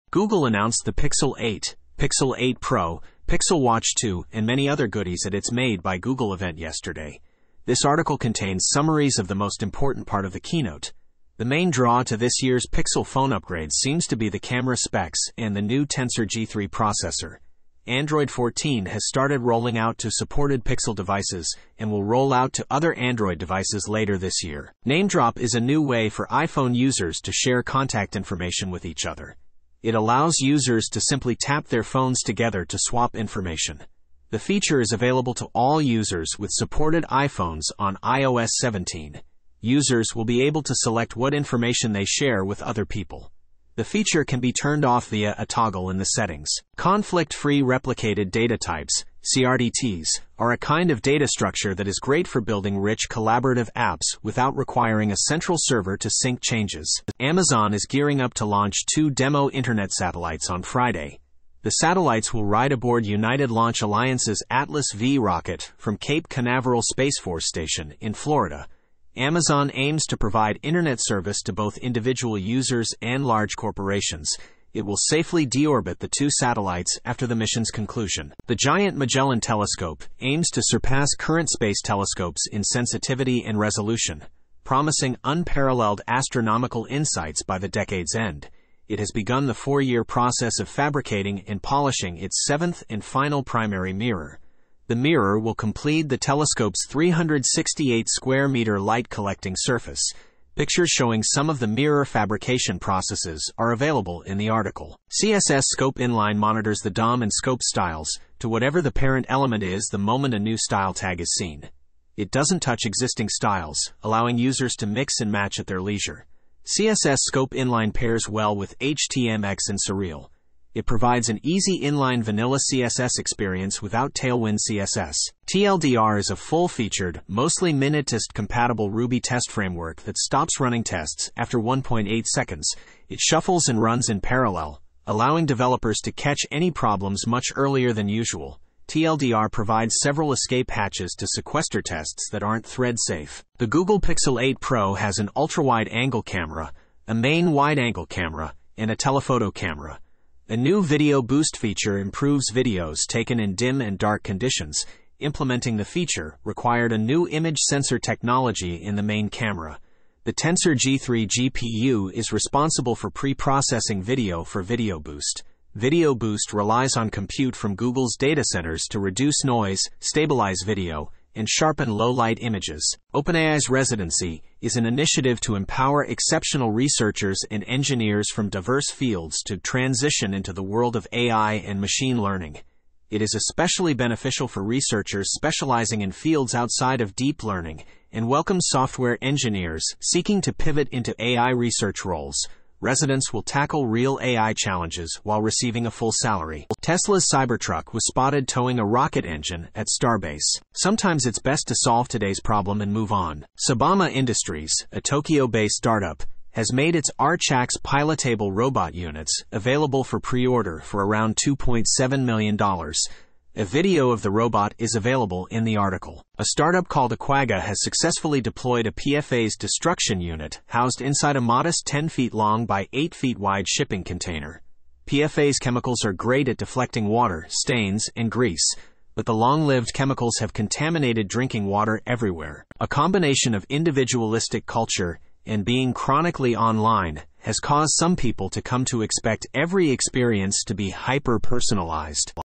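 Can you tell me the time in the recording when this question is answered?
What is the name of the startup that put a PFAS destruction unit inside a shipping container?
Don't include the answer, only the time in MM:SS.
03:37.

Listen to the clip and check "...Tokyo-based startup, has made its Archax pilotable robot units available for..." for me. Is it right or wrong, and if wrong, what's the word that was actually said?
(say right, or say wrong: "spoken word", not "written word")
right.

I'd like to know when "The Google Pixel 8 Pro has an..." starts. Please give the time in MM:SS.
02:23.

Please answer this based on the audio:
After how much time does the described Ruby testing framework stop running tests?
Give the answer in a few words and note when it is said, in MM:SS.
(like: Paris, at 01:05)
1.8 seconds, at 02:11.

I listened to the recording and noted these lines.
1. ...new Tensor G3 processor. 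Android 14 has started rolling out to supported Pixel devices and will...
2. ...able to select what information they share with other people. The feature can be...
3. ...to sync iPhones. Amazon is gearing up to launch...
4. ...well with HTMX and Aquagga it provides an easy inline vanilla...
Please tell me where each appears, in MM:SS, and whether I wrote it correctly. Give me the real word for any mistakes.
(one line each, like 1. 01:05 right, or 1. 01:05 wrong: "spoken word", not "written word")
1. 00:15 right
2. 00:40 right
3. 00:55 wrong: "changes", not "iPhones"
4. 01:58 wrong: "Surreal", not "Aquagga".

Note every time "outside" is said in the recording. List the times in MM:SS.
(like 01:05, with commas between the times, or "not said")
03:06.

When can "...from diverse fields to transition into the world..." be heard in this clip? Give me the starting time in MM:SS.
02:58.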